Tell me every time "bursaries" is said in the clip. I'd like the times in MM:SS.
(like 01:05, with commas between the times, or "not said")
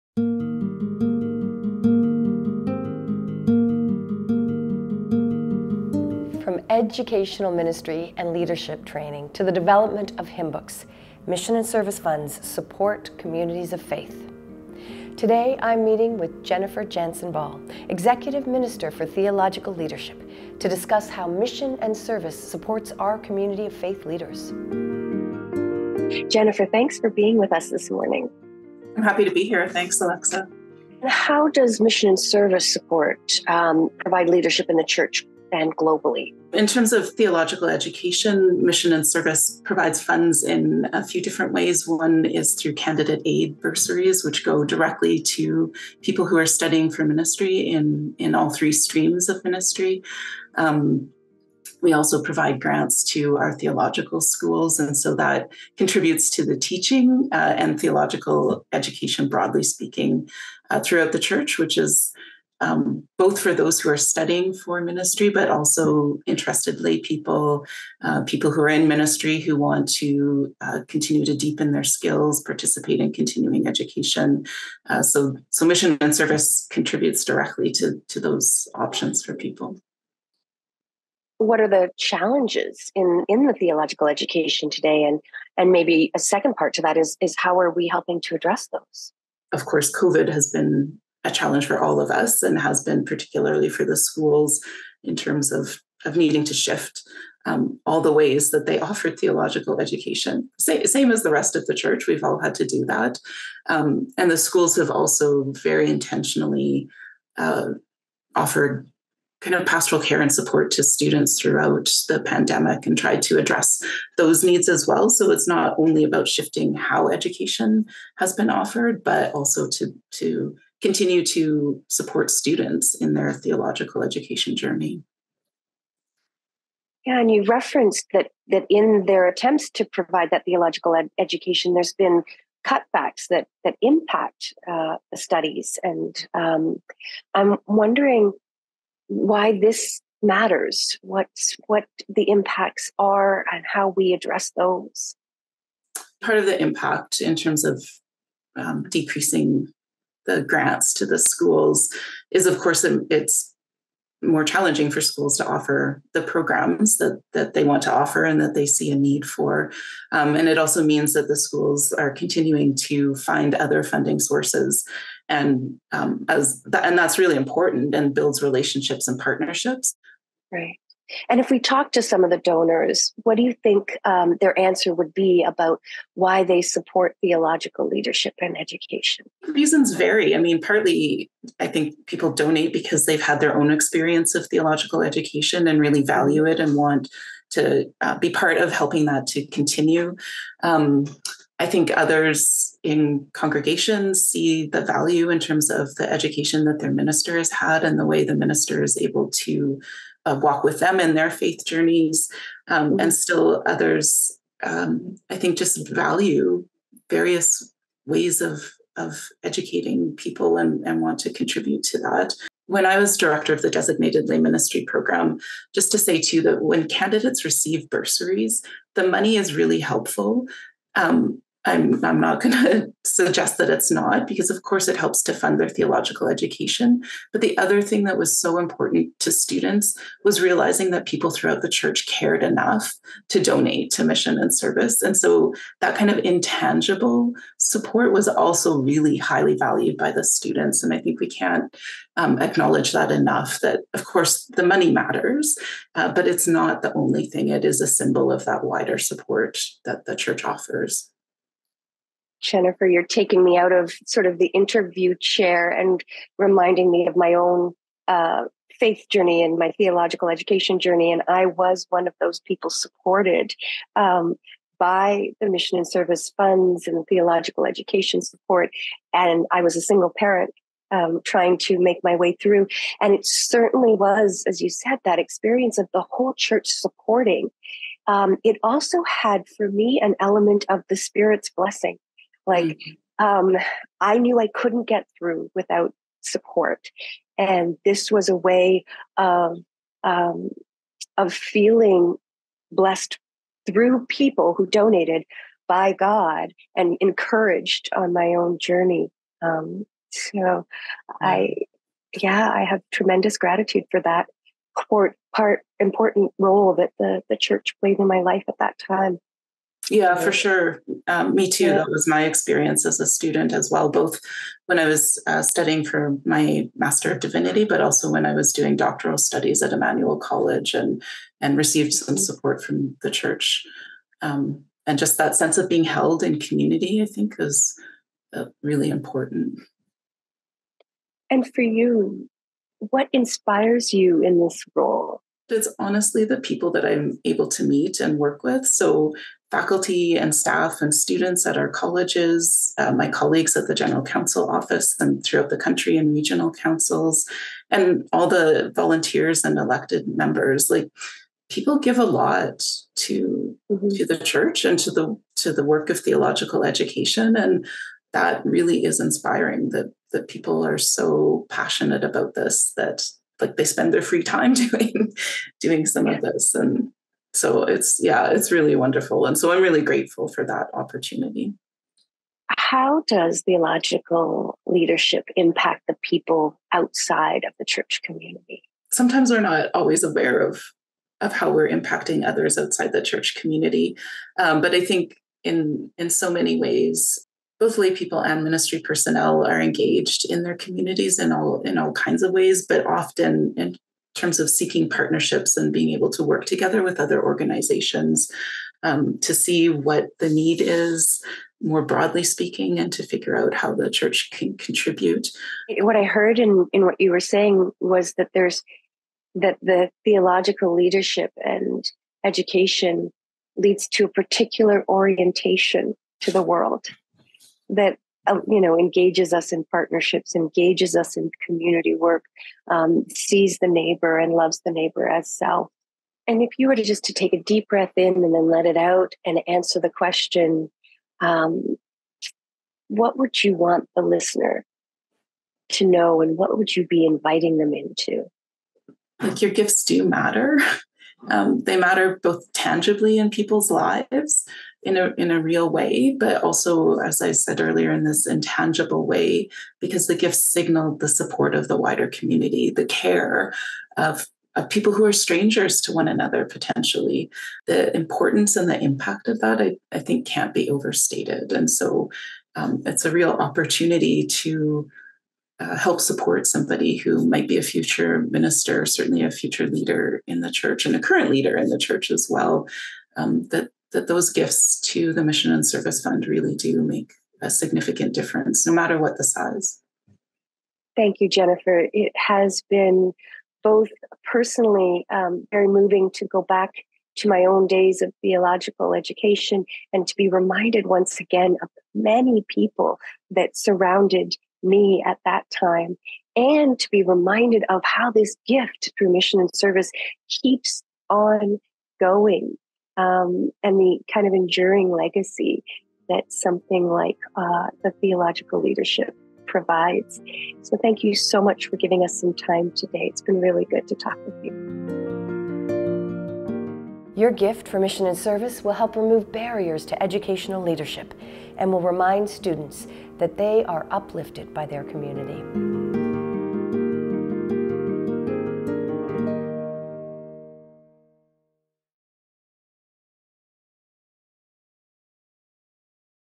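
00:43, 03:37.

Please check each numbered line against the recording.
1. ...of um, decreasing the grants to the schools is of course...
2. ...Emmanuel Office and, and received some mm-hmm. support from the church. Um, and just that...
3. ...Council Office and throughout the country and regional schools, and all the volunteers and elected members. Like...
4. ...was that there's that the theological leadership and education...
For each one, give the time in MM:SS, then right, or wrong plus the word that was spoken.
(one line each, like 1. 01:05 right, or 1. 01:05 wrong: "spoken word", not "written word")
1. 02:27 right
2. 05:19 wrong: "College", not "Office"
3. 05:44 wrong: "councils", not "schools"
4. 06:47 right.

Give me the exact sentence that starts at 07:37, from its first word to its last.
The importance and the impact of that, I, I think, can't be overstated.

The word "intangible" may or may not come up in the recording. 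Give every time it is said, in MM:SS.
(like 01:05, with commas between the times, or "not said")
03:56, 07:28.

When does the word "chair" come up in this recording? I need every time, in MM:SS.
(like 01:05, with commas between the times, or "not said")
04:15.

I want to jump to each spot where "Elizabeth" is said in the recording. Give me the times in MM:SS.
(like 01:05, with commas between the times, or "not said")
not said.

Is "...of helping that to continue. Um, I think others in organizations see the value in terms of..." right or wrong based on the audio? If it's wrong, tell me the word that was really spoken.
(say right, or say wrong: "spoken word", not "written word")
wrong: "congregations", not "organizations".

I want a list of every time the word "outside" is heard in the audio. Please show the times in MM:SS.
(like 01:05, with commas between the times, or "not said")
06:16, 06:22.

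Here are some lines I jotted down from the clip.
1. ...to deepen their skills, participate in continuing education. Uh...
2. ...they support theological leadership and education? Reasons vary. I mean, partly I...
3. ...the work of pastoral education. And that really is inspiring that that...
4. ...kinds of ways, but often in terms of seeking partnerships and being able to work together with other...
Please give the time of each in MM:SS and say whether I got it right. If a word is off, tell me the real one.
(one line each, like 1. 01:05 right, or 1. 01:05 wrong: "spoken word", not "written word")
1. 01:11 right
2. 02:56 right
3. 05:55 wrong: "theological", not "pastoral"
4. 06:31 right.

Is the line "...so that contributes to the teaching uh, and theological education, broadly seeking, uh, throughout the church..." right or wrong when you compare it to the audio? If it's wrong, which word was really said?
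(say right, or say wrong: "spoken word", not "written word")
wrong: "speaking", not "seeking".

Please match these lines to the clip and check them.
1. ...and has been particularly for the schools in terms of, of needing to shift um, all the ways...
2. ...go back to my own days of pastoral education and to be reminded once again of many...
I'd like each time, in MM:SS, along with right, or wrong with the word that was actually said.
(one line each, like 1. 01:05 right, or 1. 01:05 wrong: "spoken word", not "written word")
1. 01:32 right
2. 08:06 wrong: "theological", not "pastoral".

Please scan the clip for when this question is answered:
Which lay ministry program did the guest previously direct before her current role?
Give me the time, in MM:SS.
03:33.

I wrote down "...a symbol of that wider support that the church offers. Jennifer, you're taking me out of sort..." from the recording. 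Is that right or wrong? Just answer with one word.
right.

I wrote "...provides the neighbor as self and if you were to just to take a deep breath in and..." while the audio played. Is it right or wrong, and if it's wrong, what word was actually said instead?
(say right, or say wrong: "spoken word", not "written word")
wrong: "loves", not "provides".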